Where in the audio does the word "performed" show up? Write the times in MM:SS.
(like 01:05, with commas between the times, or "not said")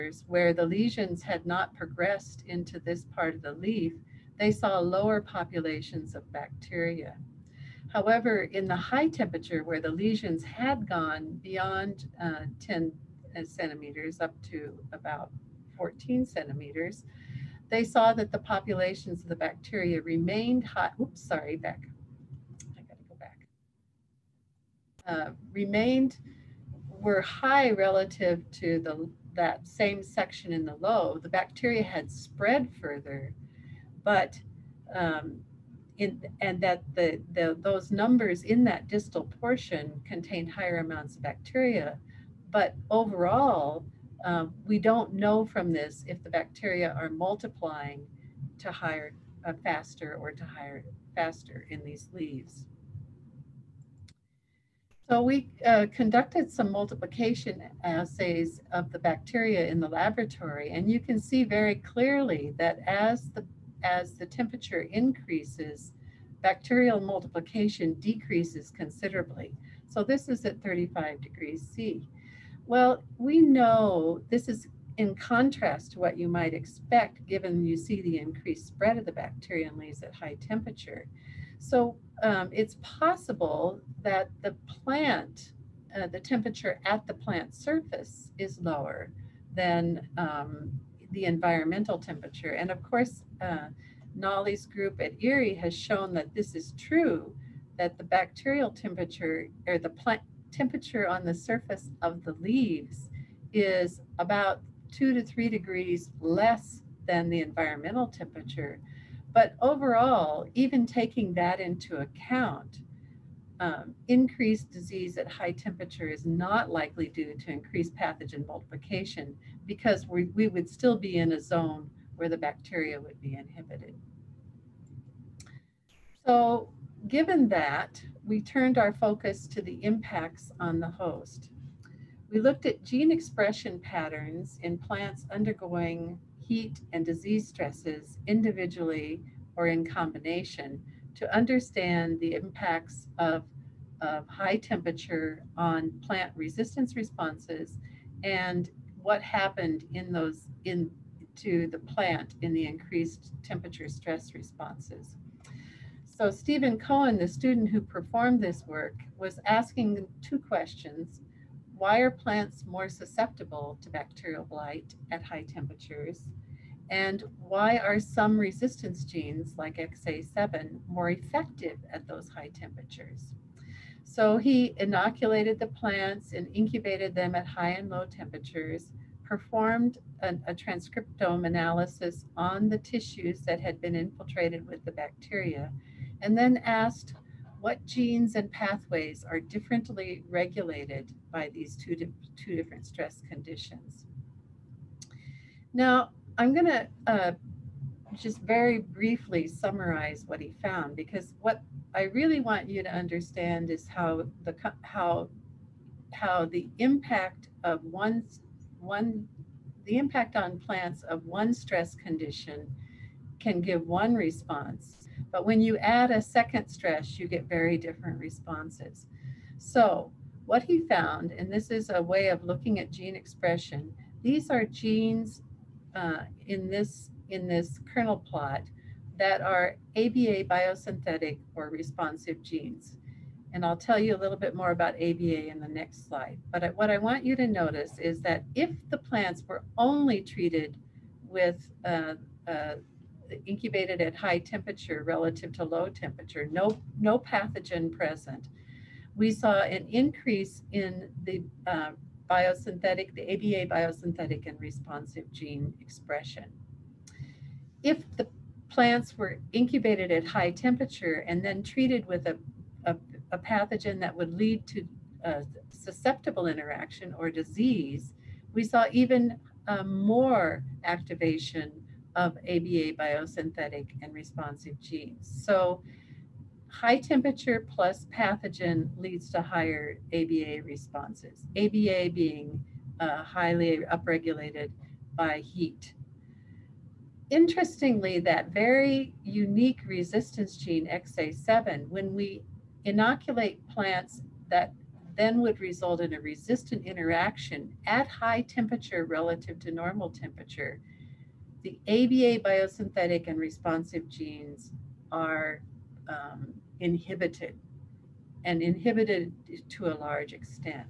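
02:37, 02:59.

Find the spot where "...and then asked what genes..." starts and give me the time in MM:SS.
03:06.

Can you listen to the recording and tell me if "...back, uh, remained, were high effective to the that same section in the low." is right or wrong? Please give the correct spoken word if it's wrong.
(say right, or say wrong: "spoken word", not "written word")
wrong: "relative", not "effective".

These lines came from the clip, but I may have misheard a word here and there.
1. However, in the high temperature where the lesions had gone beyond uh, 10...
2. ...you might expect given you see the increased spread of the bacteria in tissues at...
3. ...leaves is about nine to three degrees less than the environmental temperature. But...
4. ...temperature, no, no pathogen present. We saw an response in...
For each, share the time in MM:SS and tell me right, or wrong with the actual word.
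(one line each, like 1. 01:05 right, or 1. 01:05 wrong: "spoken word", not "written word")
1. 00:07 right
2. 01:16 wrong: "leaves", not "tissues"
3. 01:42 wrong: "two", not "nine"
4. 04:05 wrong: "increase", not "response".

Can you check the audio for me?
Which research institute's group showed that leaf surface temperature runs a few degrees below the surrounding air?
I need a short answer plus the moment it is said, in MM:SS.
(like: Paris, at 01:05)
IRRI, at 01:35.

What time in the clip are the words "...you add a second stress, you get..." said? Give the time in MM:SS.
03:35.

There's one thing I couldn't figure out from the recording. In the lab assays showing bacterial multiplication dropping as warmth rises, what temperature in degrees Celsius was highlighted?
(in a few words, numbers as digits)
35.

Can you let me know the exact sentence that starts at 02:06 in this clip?
So Given that, we turned our focus to the impacts on the host.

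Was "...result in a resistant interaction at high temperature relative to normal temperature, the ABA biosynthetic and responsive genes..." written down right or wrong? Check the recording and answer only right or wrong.
right.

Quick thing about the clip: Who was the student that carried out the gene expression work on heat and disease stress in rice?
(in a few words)
Stephen Cohen.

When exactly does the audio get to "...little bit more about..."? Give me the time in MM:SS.
03:54.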